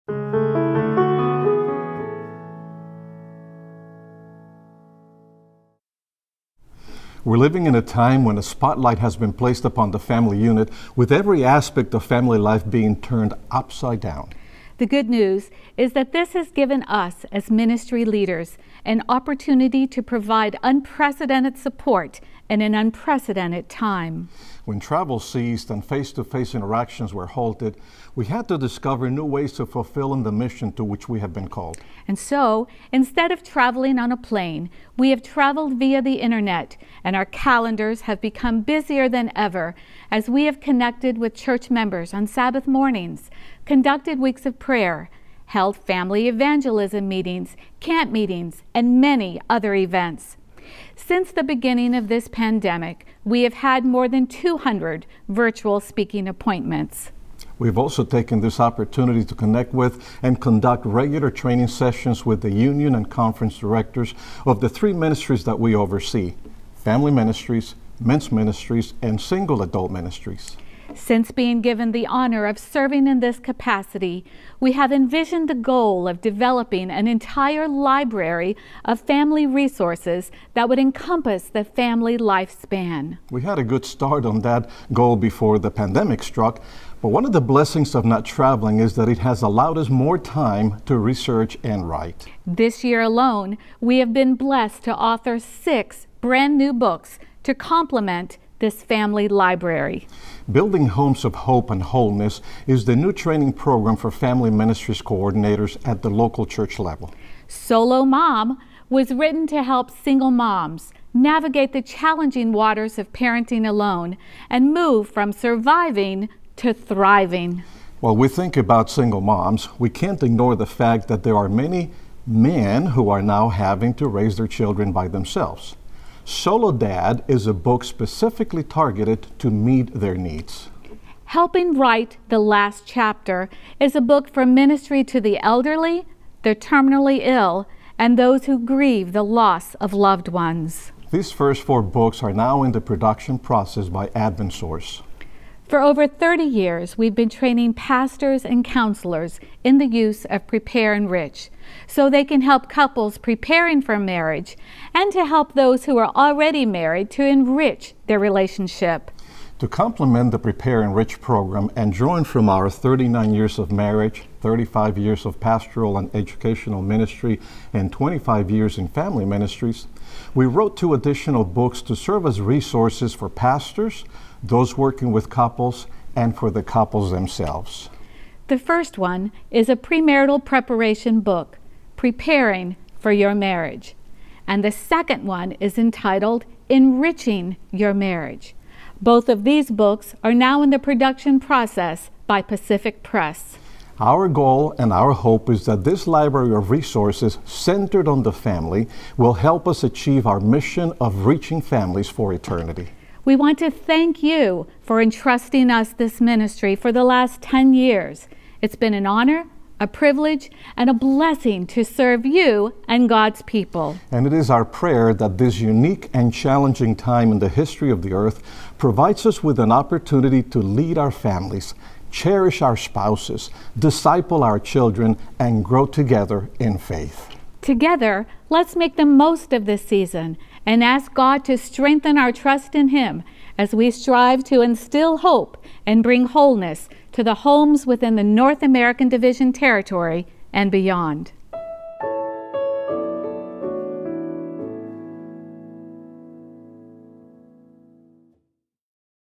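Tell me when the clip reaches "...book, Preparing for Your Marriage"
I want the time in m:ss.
3:01.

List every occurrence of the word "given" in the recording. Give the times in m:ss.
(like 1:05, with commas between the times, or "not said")
0:16, 1:11.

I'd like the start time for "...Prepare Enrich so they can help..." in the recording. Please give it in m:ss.
2:30.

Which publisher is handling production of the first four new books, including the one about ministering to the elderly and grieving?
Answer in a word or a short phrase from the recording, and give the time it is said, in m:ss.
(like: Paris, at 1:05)
AdventSource, at 2:24.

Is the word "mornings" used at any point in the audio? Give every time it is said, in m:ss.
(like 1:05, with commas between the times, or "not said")
0:42.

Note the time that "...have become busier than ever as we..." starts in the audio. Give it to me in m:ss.
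0:38.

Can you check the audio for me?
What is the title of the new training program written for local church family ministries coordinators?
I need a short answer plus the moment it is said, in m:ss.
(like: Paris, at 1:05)
Building Homes of Hope and Wholeness, at 1:40.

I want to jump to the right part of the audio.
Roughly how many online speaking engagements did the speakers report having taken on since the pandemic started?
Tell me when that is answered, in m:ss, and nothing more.
0:53.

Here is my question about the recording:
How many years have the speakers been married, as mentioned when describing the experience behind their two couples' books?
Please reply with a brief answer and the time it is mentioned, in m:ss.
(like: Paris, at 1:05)
39, at 2:42.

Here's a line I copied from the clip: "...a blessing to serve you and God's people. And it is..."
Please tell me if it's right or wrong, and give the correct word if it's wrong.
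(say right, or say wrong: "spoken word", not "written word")
right.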